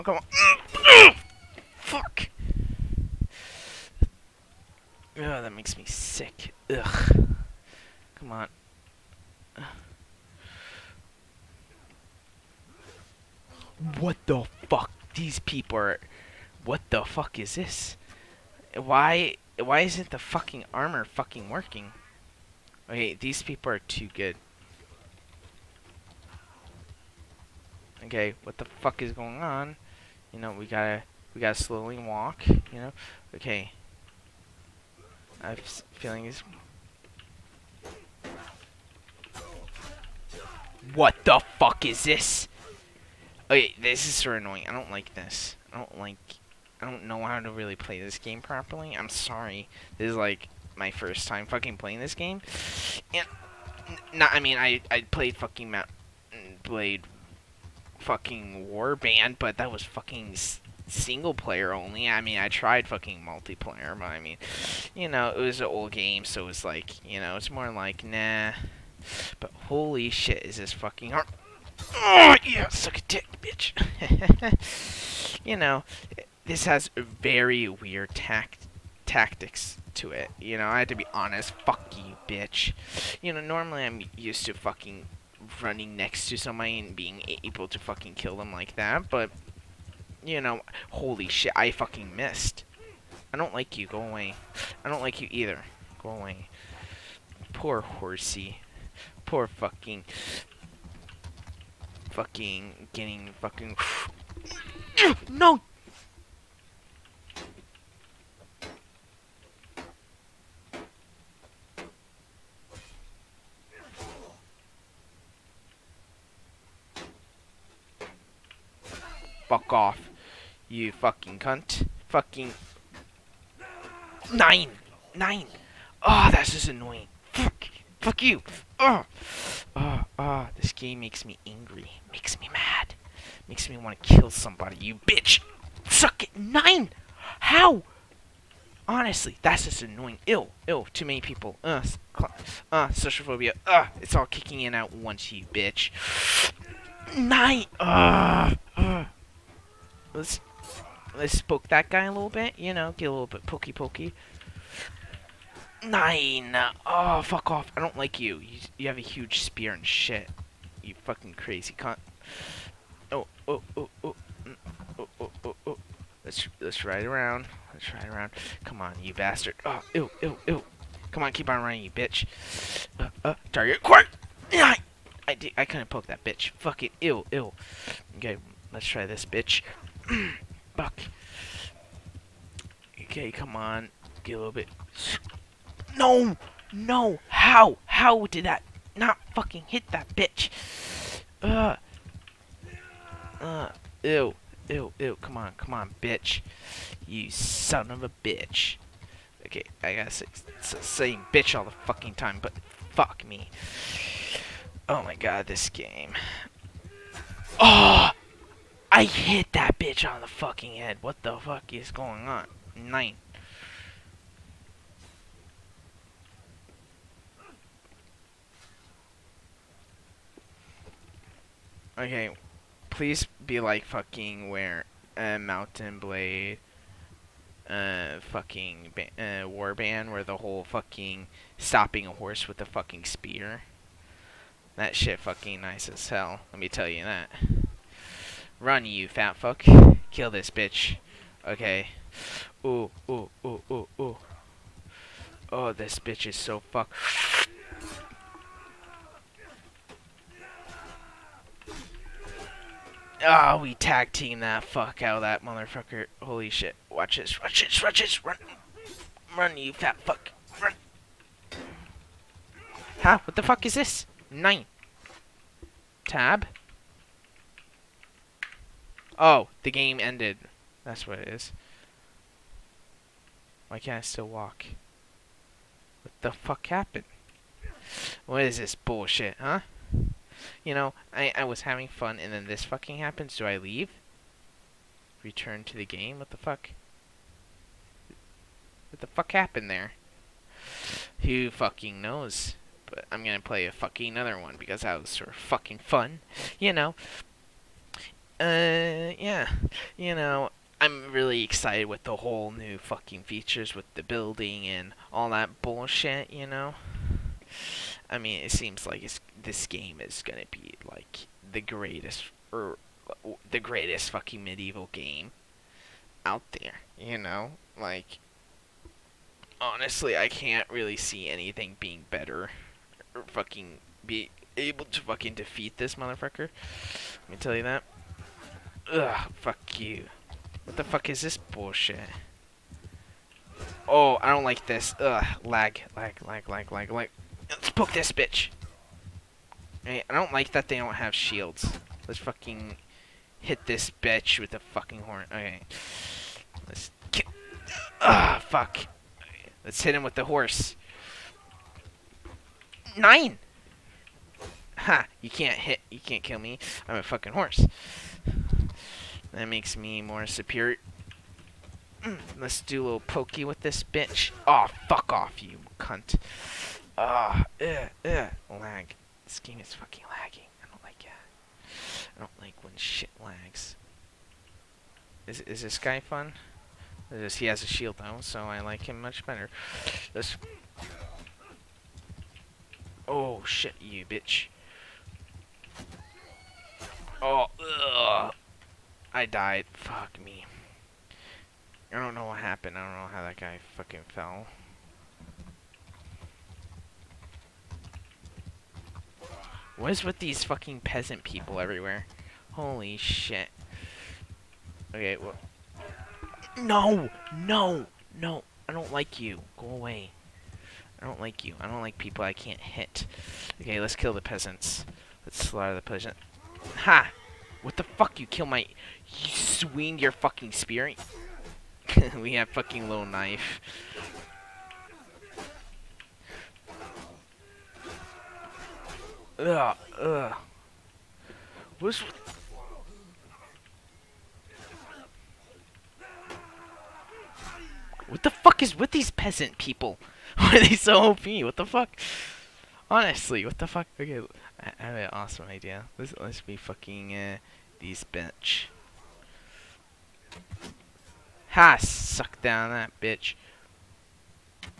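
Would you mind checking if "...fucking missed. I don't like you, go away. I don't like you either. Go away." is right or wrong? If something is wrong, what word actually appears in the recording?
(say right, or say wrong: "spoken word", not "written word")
right.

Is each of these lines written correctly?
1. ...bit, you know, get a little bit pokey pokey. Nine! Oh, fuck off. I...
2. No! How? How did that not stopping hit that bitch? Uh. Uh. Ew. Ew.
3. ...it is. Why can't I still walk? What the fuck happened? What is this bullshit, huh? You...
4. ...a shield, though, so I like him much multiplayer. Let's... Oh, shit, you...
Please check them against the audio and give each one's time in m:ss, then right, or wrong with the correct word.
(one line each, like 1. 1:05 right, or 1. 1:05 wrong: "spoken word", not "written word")
1. 2:32 right
2. 3:06 wrong: "fucking", not "stopping"
3. 4:31 right
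4. 6:17 wrong: "better", not "multiplayer".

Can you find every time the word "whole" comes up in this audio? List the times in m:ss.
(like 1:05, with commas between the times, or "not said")
3:50, 5:02.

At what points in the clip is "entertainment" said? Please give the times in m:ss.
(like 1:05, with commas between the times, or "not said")
not said.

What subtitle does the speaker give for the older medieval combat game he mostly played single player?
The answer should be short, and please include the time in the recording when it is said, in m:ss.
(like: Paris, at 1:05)
Warband, at 0:58.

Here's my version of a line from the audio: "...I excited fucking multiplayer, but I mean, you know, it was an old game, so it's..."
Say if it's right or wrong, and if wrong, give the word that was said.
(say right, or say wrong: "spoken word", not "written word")
wrong: "tried", not "excited".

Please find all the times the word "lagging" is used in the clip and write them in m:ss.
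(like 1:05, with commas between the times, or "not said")
6:10.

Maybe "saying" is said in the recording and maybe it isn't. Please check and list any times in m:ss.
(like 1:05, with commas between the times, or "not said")
3:20.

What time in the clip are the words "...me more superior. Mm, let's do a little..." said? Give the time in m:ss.
5:59.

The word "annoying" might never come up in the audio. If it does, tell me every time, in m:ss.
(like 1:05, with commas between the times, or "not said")
0:44, 2:06, 2:19.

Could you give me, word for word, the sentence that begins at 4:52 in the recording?
But I'm gonna play a fucking other one because that was sort of fucking fun.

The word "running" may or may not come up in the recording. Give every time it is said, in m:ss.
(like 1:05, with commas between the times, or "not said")
1:25, 2:51.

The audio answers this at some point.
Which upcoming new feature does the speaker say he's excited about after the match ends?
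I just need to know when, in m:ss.
5:04.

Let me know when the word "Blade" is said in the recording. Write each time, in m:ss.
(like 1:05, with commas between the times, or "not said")
0:56, 3:46.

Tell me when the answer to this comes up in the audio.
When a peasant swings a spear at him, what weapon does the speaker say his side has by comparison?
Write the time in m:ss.
7:02.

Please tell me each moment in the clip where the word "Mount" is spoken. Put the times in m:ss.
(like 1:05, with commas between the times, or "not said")
0:55, 3:45.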